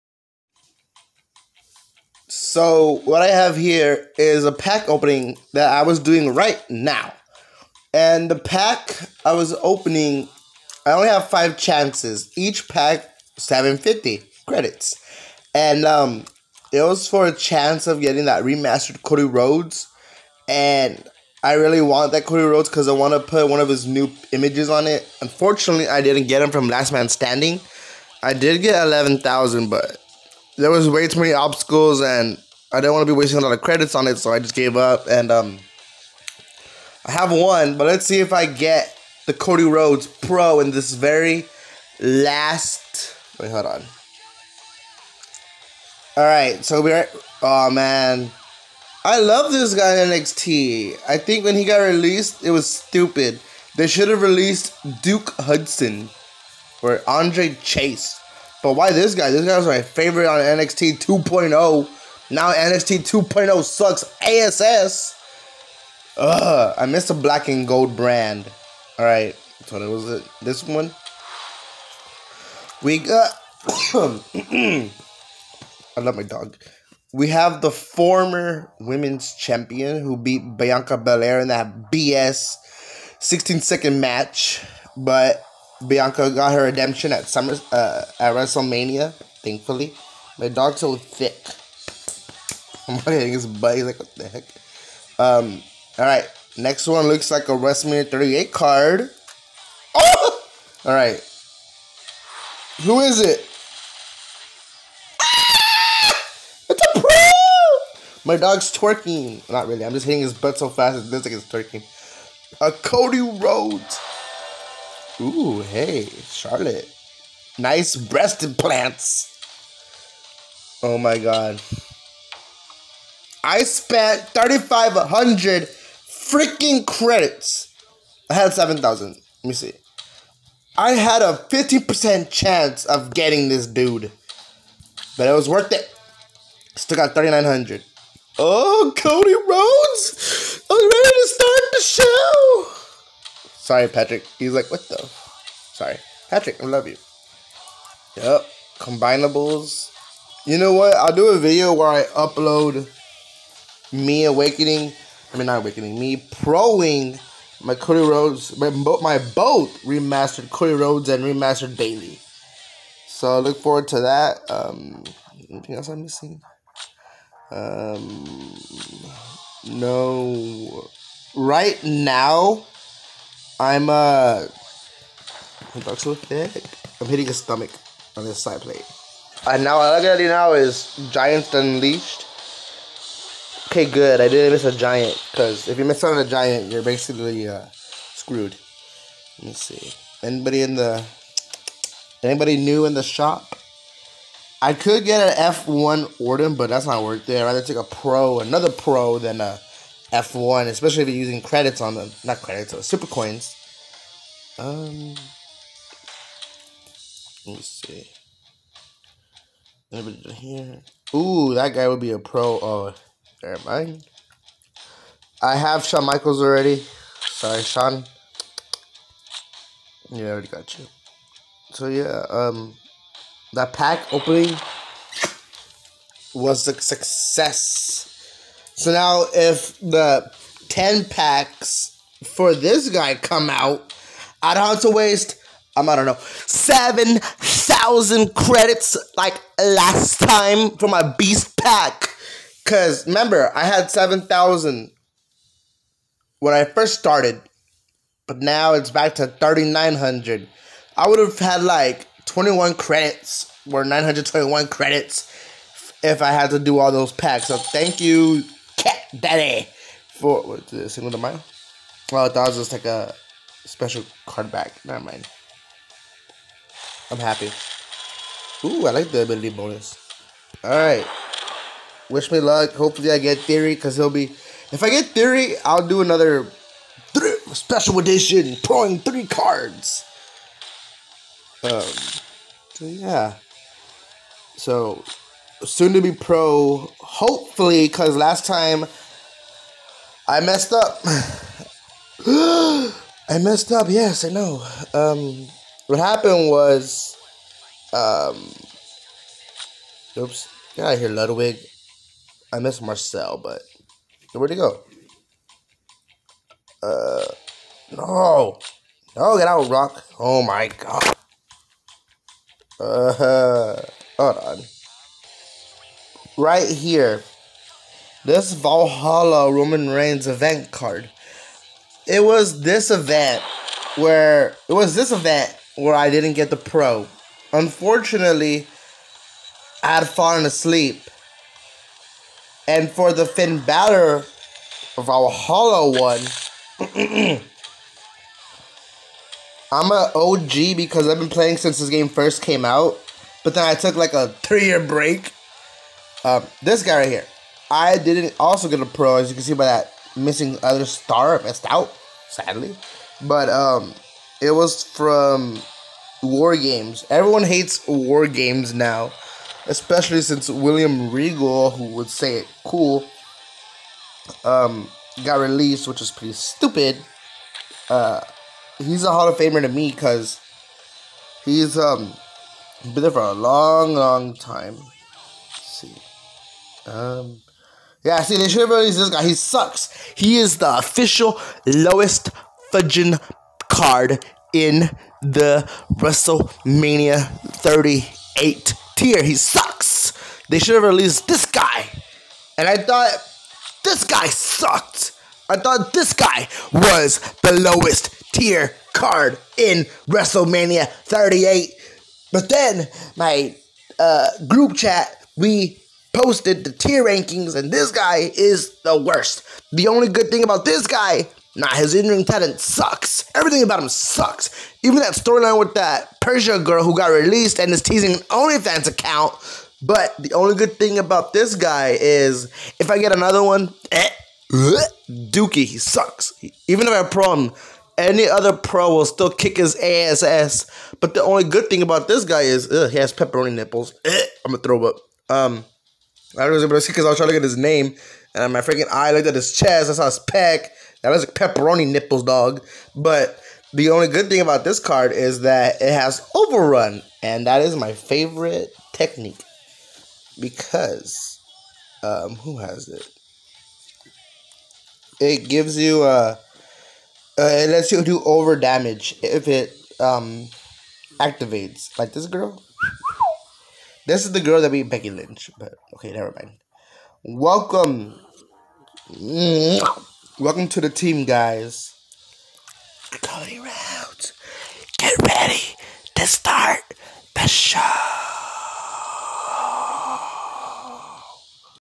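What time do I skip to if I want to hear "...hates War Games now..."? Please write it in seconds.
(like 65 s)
357 s.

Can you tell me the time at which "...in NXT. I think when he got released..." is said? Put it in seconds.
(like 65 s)
50 s.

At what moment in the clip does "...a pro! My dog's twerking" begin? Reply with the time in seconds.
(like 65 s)
106 s.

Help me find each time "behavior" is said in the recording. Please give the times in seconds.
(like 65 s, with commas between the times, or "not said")
not said.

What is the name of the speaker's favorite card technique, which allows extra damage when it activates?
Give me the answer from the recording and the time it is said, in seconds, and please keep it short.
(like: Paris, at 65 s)
Overrun, at 446 s.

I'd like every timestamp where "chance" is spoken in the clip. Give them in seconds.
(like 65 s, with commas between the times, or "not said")
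11 s, 17 s, 132 s.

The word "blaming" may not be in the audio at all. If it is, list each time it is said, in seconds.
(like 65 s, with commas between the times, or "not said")
not said.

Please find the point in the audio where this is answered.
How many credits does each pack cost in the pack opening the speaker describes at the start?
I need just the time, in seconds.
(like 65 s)
13 s.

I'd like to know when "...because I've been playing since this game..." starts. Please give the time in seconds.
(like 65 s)
340 s.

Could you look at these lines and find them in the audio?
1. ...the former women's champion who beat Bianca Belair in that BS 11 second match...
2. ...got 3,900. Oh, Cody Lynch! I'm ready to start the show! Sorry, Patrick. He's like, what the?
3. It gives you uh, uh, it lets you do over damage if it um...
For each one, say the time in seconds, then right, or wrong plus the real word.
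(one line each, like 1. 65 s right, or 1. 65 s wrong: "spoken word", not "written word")
1. 77 s wrong: "16", not "11"
2. 136 s wrong: "Rhodes", not "Lynch"
3. 455 s right.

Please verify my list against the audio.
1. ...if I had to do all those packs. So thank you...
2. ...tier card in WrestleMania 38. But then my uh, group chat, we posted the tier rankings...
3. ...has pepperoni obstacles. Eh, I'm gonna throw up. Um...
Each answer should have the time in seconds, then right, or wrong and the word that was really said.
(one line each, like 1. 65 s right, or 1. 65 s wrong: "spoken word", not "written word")
1. 256 s right
2. 398 s right
3. 432 s wrong: "nipples", not "obstacles".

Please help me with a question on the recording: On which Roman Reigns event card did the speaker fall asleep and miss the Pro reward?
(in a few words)
Valhalla.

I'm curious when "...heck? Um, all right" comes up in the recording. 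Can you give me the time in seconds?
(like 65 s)
94 s.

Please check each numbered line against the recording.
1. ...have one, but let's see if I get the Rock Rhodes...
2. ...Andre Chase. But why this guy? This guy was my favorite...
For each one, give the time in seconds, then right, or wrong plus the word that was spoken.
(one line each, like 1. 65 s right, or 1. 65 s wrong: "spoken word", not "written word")
1. 37 s wrong: "Cody", not "Rock"
2. 57 s right.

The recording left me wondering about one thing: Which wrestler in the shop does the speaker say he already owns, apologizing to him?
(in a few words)
Shawn Michaels.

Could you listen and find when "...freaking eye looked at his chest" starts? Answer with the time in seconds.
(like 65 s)
438 s.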